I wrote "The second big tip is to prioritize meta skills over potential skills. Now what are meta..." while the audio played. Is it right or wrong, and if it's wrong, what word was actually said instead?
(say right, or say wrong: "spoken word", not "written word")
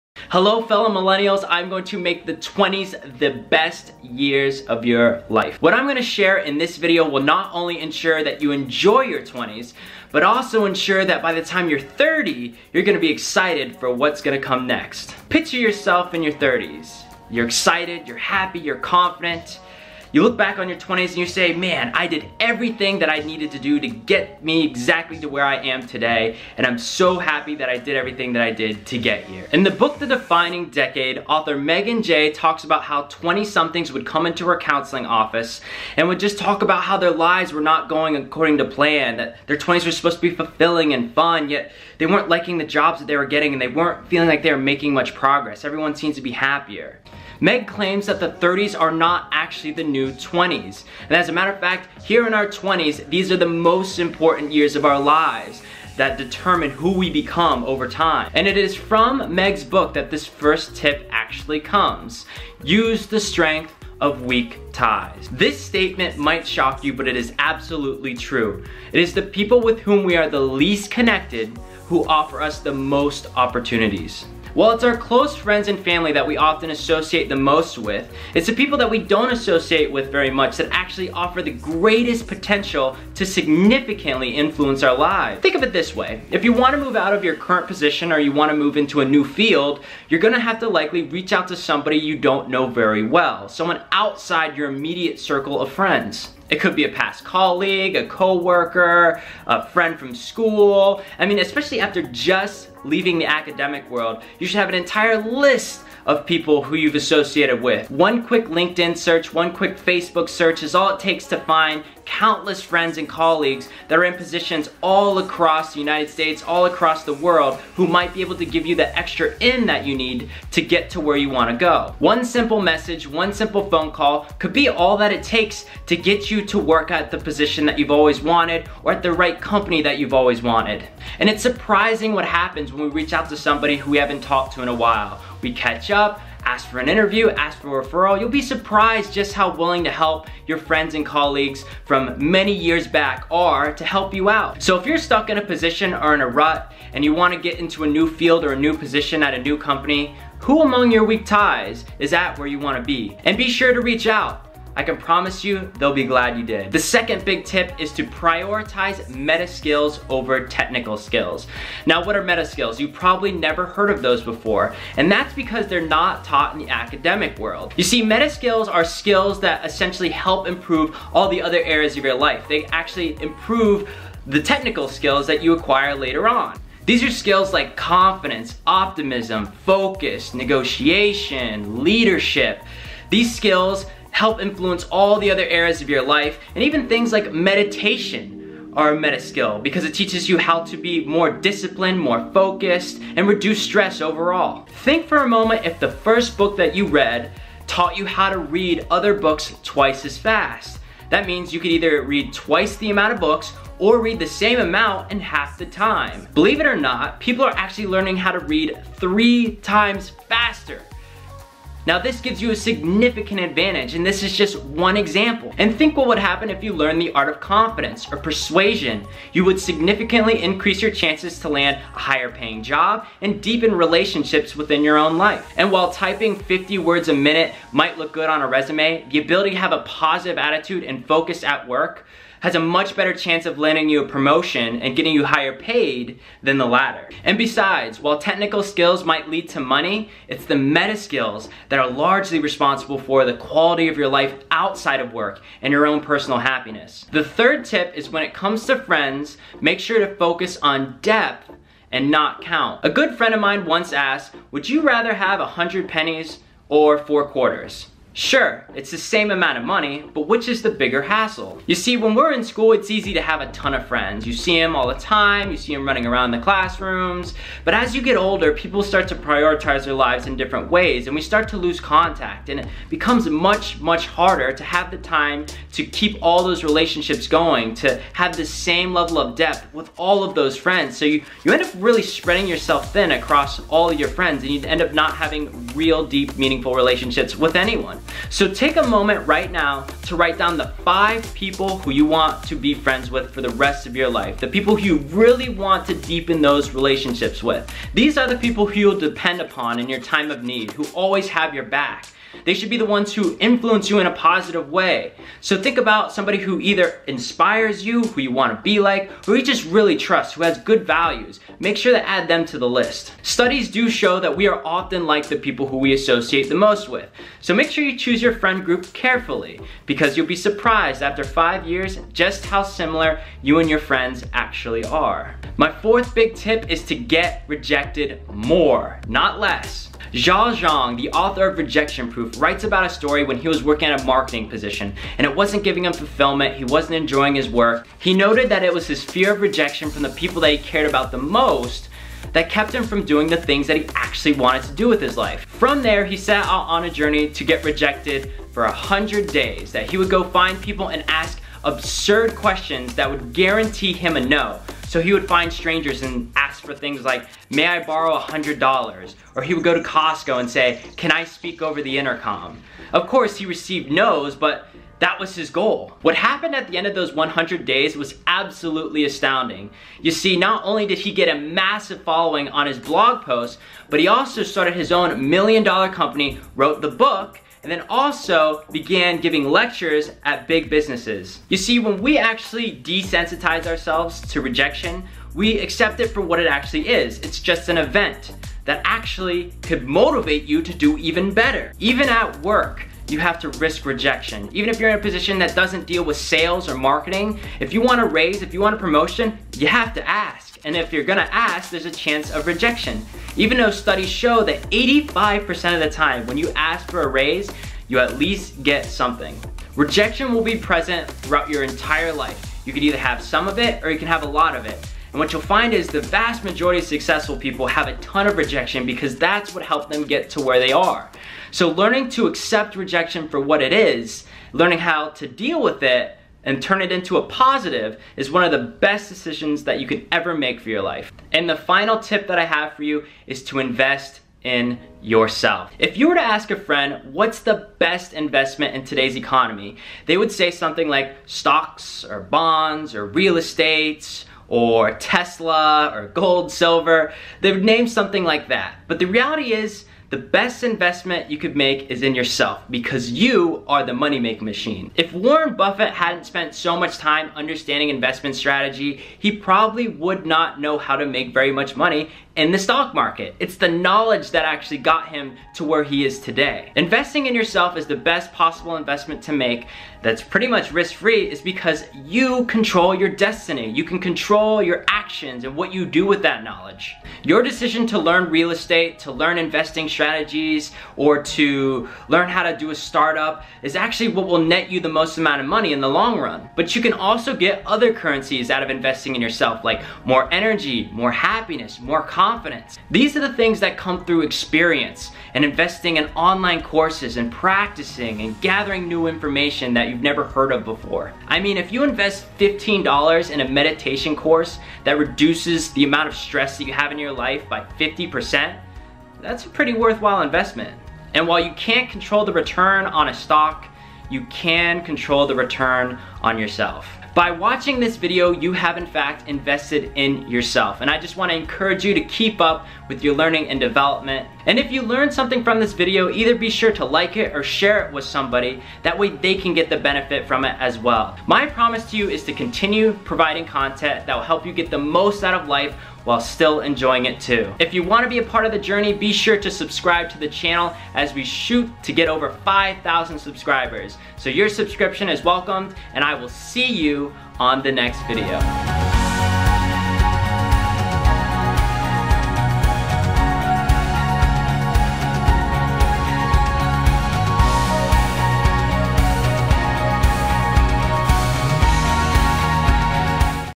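wrong: "technical", not "potential".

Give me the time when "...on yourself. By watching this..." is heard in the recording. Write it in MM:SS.
08:36.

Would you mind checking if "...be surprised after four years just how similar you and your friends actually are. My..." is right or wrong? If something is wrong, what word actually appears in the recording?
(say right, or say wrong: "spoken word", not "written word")
wrong: "five", not "four".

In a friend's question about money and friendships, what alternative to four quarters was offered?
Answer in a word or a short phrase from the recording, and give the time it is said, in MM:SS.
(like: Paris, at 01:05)
100 pennies, at 04:15.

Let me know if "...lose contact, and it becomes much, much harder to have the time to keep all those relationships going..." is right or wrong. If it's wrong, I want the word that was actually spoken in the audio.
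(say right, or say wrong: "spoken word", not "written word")
right.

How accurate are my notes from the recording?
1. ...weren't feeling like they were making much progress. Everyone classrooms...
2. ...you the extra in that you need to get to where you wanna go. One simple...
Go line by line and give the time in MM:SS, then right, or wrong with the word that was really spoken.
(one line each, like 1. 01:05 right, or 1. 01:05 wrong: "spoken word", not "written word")
1. 00:43 wrong: "seems", not "classrooms"
2. 01:58 right.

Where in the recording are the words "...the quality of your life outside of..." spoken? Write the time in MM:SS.
04:03.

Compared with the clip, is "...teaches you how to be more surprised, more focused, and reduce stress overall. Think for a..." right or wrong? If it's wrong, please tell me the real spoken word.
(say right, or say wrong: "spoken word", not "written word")
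wrong: "disciplined", not "surprised".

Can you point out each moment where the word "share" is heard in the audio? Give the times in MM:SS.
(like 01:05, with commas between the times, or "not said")
00:06, 08:47.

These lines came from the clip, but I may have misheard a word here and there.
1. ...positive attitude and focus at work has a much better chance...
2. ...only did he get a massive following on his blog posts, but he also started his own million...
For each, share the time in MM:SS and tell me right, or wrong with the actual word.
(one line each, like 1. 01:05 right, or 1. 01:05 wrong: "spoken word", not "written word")
1. 03:49 right
2. 06:10 right.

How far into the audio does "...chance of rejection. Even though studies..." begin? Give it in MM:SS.
06:41.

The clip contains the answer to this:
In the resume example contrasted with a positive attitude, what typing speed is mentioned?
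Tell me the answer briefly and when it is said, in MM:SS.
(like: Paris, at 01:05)
50 words a minute, at 03:46.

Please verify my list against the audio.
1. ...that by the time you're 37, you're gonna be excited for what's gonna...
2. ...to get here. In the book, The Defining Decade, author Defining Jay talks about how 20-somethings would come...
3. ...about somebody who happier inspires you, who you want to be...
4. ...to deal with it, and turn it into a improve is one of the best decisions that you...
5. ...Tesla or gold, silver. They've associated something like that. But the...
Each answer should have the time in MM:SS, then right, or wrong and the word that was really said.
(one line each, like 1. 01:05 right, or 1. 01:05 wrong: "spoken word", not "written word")
1. 00:11 wrong: "30", not "37"
2. 00:28 wrong: "Megan", not "Defining"
3. 05:05 wrong: "either", not "happier"
4. 07:05 wrong: "positive", not "improve"
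5. 07:24 wrong: "named", not "associated".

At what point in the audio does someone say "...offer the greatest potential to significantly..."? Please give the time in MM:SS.
01:21.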